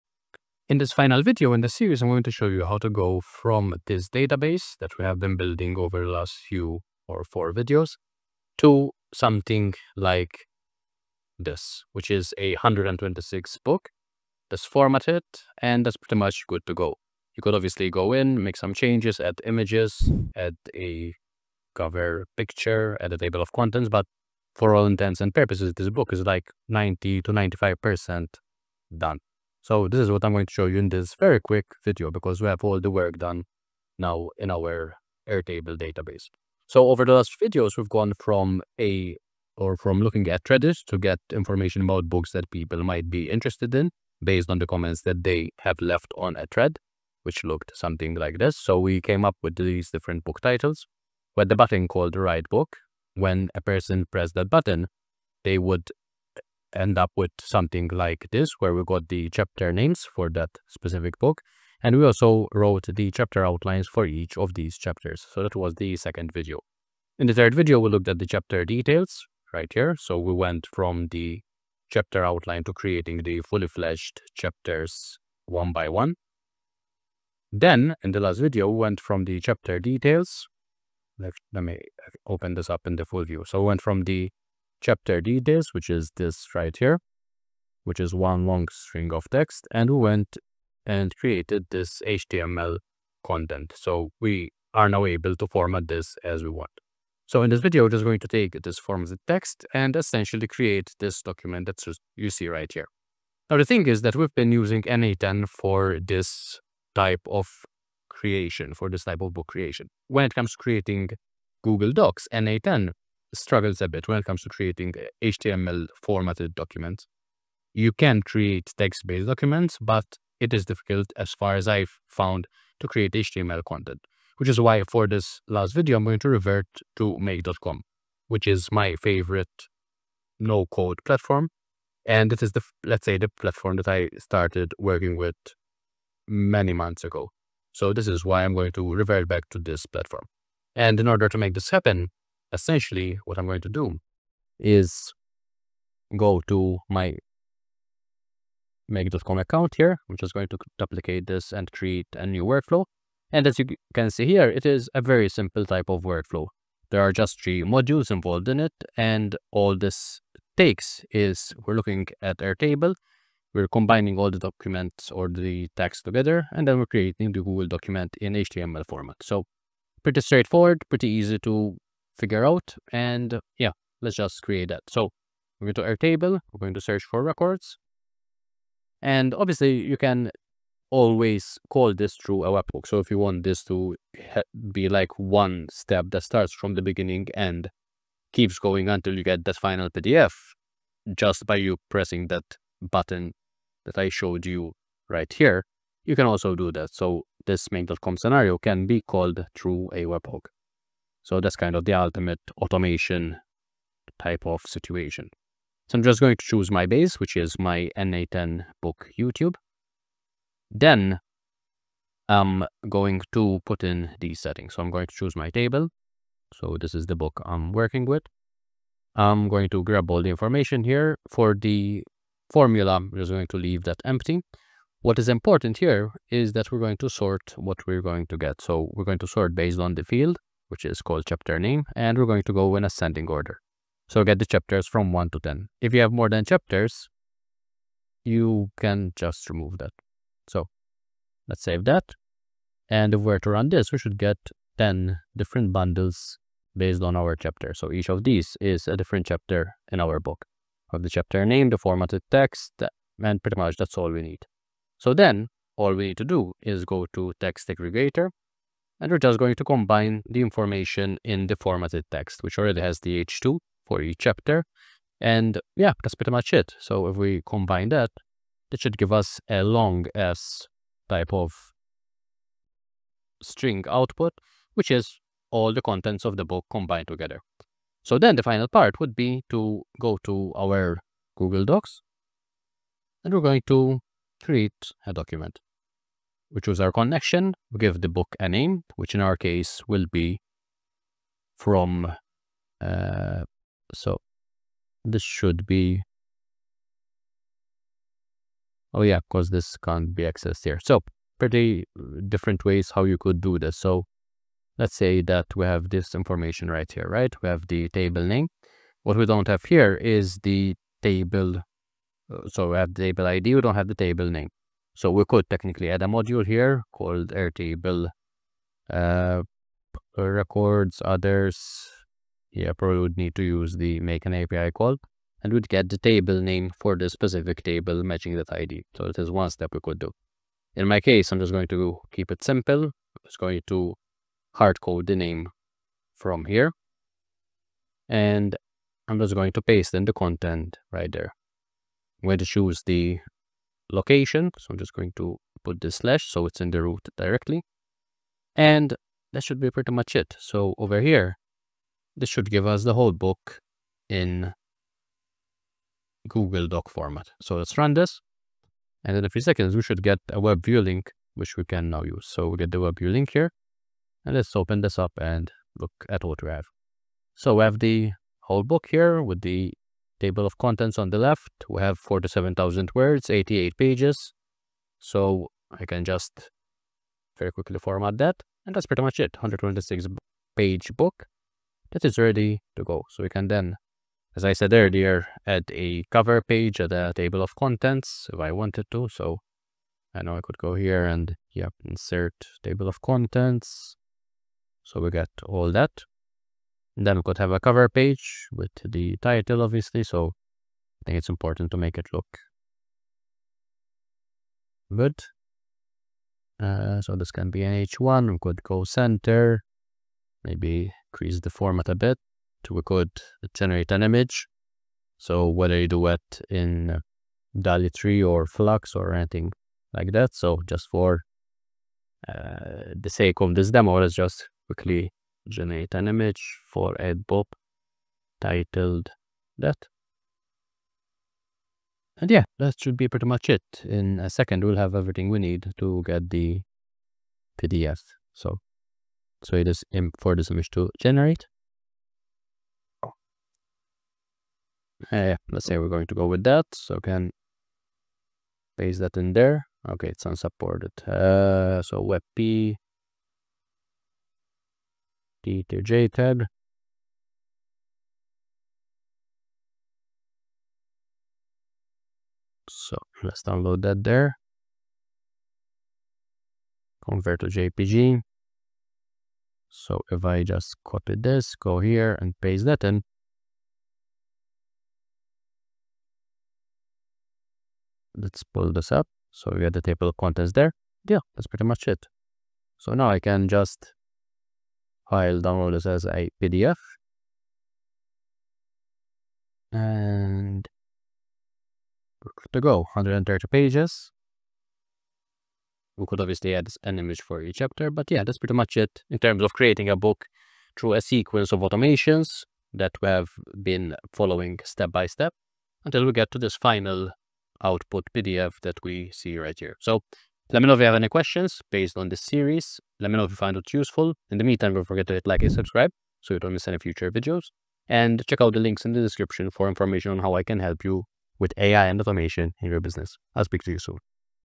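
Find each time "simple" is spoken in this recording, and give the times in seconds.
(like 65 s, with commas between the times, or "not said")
155 s, 332 s.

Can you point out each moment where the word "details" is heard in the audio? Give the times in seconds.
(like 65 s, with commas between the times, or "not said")
68 s, 79 s.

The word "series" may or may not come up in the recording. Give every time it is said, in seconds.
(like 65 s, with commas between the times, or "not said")
1 s, 512 s.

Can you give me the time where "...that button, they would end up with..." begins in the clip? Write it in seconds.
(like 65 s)
54 s.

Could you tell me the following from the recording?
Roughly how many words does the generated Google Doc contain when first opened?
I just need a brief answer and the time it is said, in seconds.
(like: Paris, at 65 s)
47,000, at 371 s.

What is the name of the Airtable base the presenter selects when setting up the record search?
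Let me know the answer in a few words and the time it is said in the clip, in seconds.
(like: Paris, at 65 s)
n8n book YouTube, at 207 s.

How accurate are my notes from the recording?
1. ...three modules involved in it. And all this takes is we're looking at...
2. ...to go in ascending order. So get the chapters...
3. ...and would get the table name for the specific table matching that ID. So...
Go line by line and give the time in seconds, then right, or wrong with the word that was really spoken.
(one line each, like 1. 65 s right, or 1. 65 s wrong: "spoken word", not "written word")
1. 157 s right
2. 232 s right
3. 325 s right.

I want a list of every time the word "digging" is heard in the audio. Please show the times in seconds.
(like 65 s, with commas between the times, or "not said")
not said.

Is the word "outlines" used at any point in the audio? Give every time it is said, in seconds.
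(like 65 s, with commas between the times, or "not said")
63 s, 72 s.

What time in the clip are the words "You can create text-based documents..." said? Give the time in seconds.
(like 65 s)
117 s.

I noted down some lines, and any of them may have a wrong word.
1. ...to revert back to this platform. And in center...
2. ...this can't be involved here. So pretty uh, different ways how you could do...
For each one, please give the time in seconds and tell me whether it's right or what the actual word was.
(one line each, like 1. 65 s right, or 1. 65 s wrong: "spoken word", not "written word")
1. 138 s wrong: "order", not "center"
2. 299 s wrong: "accessed", not "involved".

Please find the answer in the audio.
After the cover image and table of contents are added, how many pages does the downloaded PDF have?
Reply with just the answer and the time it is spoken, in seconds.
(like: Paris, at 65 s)
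130, at 492 s.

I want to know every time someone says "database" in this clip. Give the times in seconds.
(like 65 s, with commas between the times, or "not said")
4 s, 35 s.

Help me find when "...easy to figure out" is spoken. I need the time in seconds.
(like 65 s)
171 s.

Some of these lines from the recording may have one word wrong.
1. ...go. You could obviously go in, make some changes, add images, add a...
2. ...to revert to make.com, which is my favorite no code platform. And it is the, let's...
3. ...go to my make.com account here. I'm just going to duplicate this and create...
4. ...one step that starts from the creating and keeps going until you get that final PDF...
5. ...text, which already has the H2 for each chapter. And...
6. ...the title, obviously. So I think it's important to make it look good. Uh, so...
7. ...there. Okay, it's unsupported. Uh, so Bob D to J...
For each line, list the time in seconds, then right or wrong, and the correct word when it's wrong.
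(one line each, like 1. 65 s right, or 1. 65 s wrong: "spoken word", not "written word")
1. 16 s right
2. 126 s right
3. 146 s right
4. 185 s wrong: "beginning", not "creating"
5. 262 s right
6. 398 s right
7. 449 s wrong: "WebP", not "Bob".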